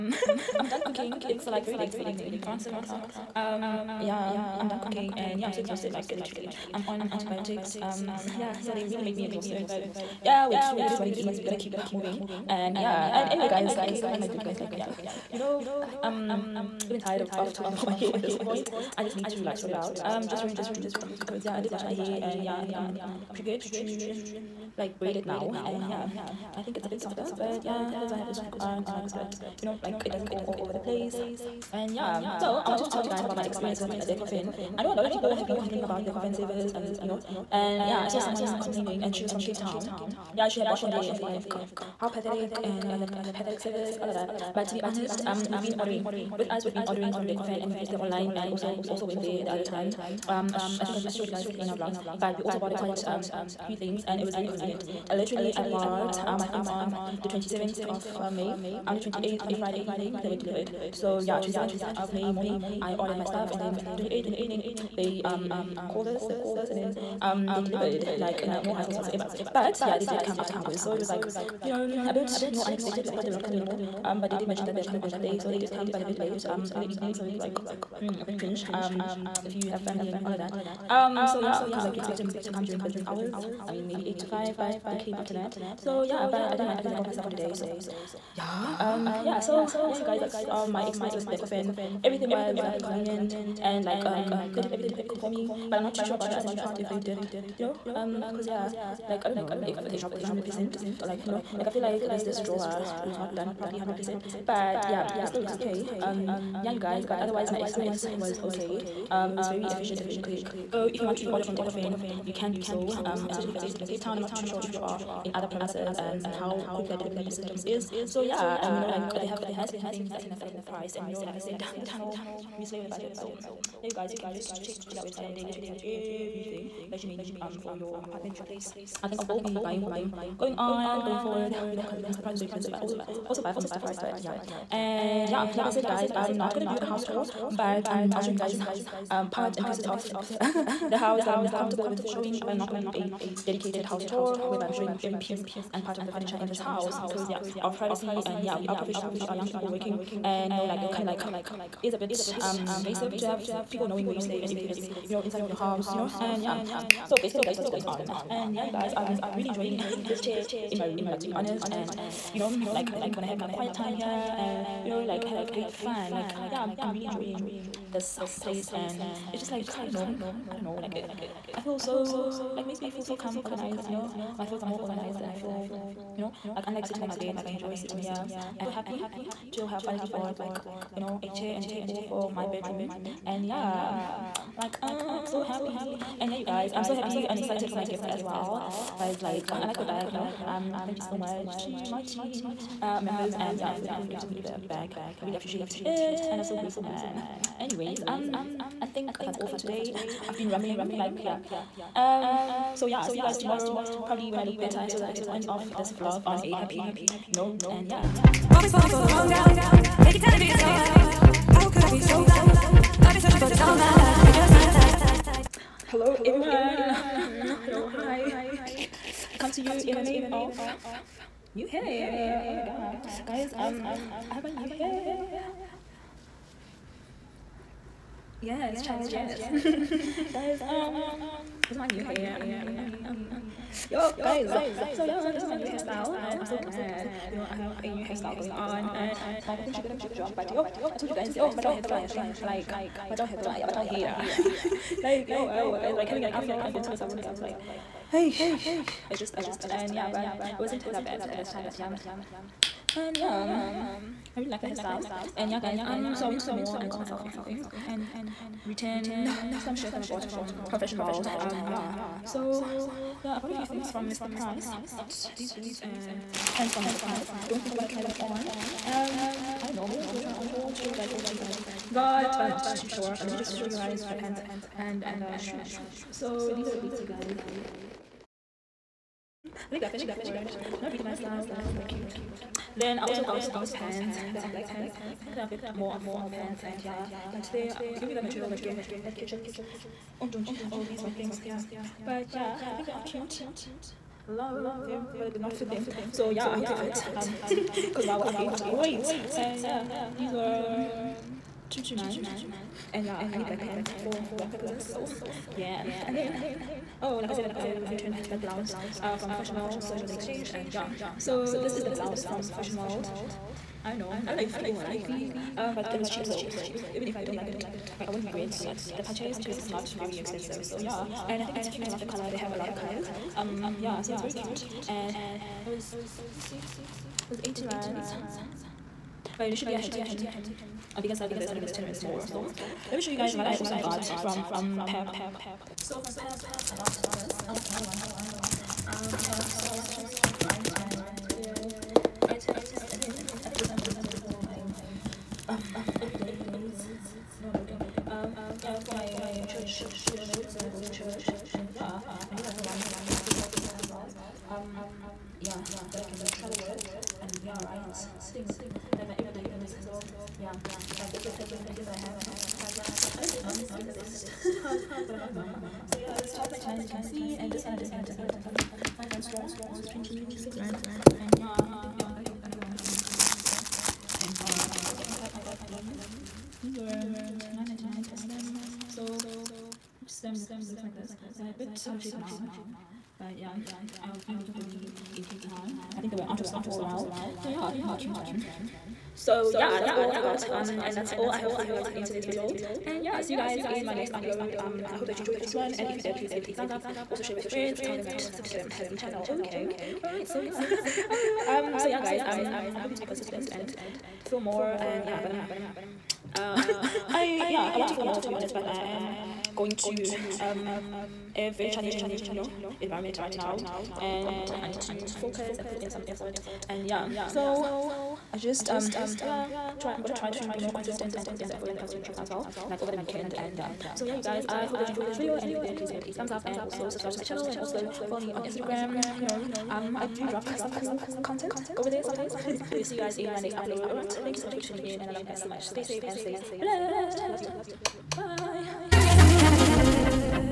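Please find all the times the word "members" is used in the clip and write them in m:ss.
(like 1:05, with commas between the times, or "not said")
3:13.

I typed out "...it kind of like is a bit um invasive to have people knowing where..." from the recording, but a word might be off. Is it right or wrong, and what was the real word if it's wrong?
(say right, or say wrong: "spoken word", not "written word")
right.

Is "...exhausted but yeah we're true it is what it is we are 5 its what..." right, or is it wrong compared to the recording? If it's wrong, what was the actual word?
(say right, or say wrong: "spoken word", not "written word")
wrong: "2", not "5".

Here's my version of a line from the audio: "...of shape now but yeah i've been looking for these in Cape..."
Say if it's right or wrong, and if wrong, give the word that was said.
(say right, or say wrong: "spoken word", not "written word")
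right.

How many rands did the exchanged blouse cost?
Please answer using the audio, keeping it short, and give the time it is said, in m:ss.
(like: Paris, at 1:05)
80 rands, at 5:27.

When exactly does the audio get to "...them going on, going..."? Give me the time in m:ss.
2:09.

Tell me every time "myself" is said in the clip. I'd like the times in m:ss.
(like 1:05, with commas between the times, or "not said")
1:27, 4:16.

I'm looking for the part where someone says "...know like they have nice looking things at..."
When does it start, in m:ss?
1:58.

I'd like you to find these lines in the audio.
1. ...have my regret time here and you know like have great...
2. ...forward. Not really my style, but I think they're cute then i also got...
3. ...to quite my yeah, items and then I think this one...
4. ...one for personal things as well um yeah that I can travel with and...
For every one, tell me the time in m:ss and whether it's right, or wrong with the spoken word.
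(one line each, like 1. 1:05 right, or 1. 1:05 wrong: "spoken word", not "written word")
1. 2:43 wrong: "quiet", not "regret"
2. 4:40 right
3. 5:39 wrong: "write", not "quite"
4. 5:52 right.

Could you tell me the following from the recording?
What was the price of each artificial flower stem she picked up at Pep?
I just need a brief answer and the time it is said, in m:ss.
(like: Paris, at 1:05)
9.99, at 6:17.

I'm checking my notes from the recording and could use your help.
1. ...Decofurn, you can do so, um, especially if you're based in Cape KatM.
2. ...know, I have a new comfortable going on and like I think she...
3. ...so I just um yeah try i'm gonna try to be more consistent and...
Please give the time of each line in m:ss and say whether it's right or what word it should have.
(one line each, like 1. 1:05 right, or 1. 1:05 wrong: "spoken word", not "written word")
1. 1:51 wrong: "Town", not "KatM"
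2. 3:57 wrong: "hairstyle", not "comfortable"
3. 6:57 right.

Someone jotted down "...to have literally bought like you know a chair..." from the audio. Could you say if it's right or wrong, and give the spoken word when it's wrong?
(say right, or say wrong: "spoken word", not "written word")
wrong: "finally", not "literally".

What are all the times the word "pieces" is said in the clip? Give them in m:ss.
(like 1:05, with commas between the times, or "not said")
2:19, 2:25.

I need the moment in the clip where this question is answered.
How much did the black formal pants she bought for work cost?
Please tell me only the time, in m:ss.
5:01.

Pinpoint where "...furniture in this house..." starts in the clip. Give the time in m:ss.
2:26.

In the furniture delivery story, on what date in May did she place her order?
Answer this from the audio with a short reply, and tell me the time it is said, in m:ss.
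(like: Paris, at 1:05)
27th of May, at 0:57.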